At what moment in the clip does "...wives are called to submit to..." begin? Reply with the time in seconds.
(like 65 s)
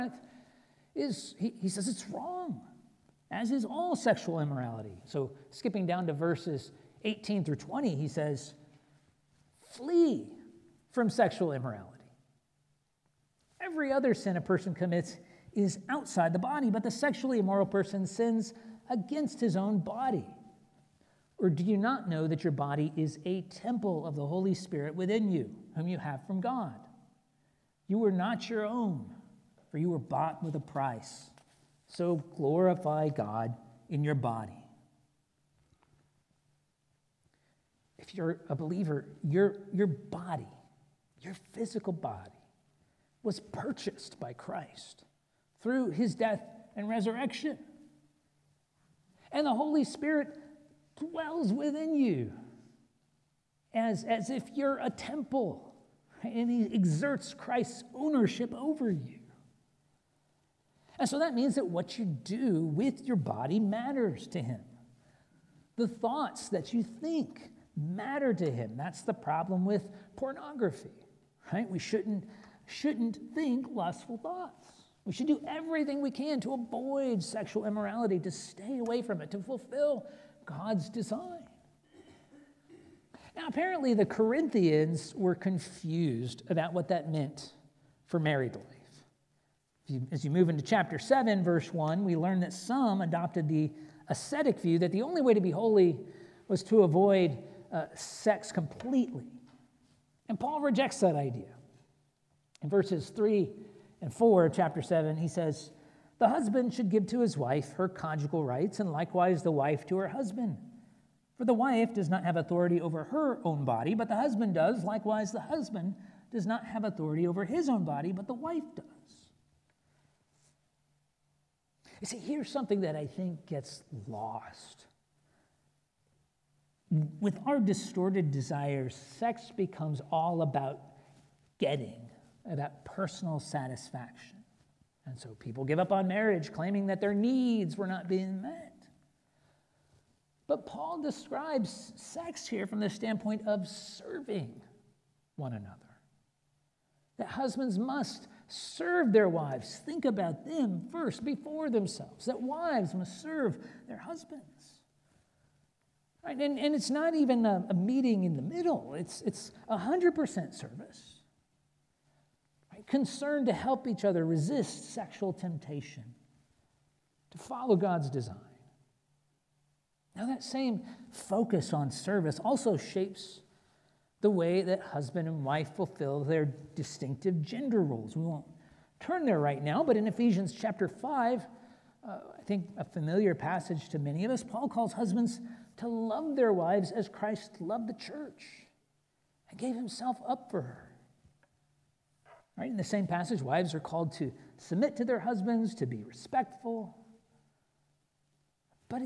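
193 s.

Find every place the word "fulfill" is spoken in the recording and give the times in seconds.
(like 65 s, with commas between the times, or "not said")
79 s, 175 s.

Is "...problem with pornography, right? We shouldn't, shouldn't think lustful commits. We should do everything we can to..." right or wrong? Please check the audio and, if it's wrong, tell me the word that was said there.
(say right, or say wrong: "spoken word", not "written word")
wrong: "thoughts", not "commits".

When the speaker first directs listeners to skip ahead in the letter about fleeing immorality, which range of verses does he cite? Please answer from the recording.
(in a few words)
18 through 20.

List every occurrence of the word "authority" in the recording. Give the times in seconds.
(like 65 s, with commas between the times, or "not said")
112 s, 116 s.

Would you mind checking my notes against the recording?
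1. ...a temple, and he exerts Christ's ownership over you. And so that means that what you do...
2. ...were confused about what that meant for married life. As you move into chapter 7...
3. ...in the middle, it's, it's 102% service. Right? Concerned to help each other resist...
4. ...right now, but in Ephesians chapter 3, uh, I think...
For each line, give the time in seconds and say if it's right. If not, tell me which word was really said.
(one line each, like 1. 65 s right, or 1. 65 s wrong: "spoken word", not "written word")
1. 54 s right
2. 85 s right
3. 158 s wrong: "100", not "102"
4. 179 s wrong: "5", not "3".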